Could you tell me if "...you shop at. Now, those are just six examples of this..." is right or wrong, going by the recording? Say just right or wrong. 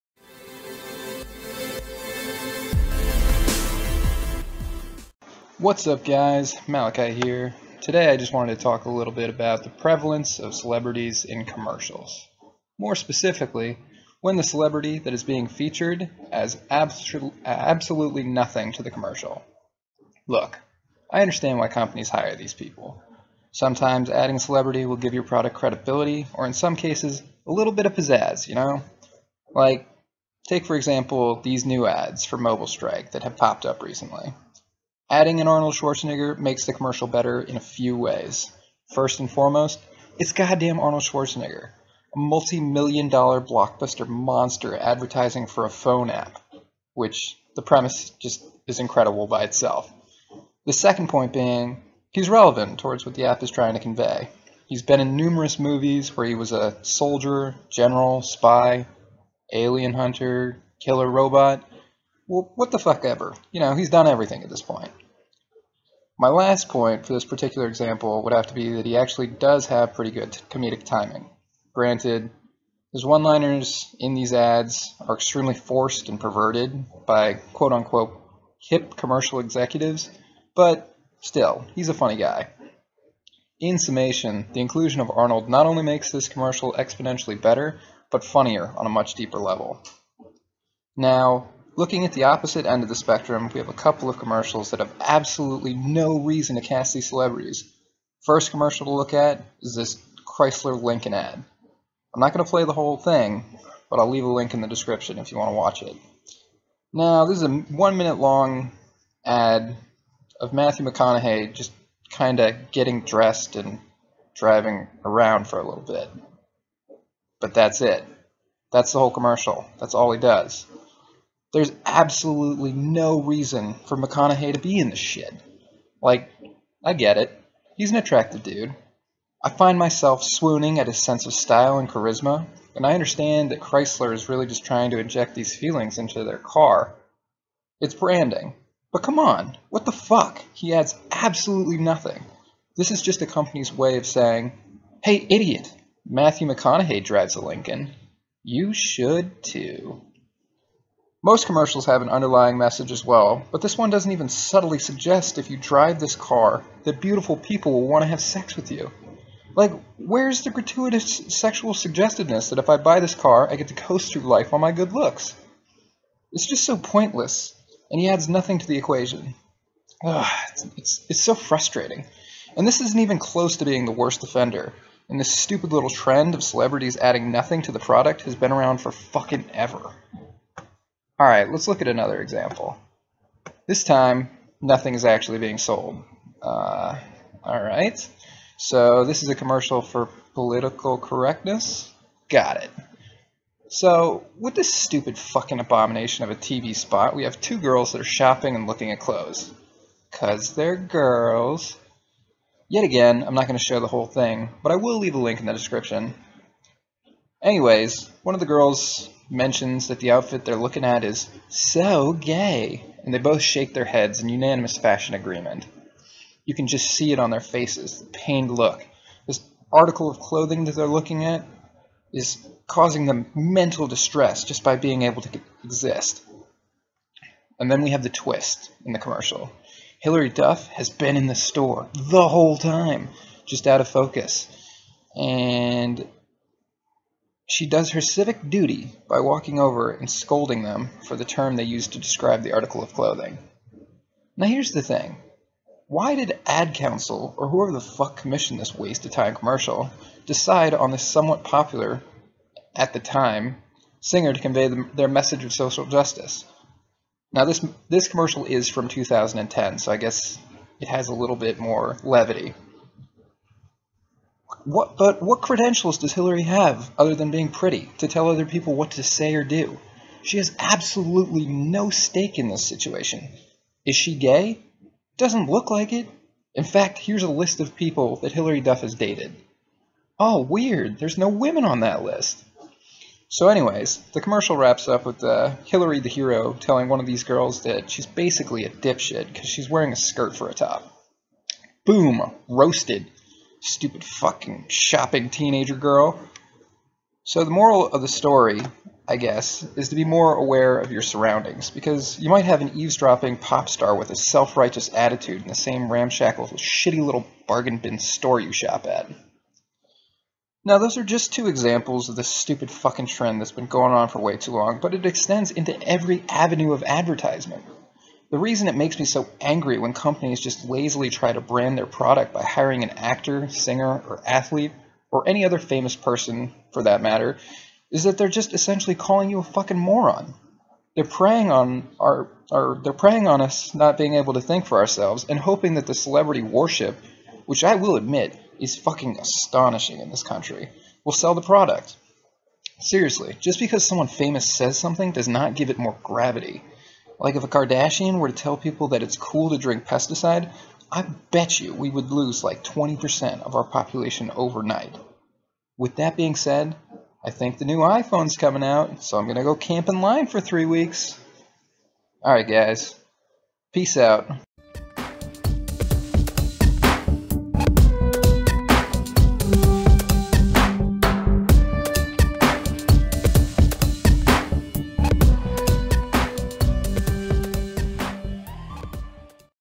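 wrong.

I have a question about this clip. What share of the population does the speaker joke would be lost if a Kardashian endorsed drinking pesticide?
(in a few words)
20%.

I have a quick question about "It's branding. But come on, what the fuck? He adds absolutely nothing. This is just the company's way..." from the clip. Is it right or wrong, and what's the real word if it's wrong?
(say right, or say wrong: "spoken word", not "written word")
right.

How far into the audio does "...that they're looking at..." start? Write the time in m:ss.
3:40.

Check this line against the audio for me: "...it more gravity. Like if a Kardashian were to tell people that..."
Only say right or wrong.
right.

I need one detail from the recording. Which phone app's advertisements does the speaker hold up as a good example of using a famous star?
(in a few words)
Mobile Strike.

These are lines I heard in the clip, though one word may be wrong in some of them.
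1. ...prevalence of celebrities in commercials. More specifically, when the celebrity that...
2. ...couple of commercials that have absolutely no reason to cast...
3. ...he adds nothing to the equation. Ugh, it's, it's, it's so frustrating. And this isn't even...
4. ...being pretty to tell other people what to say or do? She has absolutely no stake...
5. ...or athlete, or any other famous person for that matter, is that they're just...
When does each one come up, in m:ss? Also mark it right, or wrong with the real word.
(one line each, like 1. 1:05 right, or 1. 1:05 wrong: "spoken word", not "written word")
1. 0:09 right
2. 1:33 right
3. 2:48 right
4. 4:27 right
5. 5:24 right.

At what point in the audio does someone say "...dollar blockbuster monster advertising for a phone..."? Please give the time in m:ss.
0:43.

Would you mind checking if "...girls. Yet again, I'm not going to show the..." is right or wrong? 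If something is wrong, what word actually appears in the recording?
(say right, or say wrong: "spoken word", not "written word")
right.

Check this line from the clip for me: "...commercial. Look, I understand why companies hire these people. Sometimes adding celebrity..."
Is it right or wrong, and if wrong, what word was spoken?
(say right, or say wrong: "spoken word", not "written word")
right.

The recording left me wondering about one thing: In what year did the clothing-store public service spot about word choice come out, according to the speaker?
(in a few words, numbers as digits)
2010.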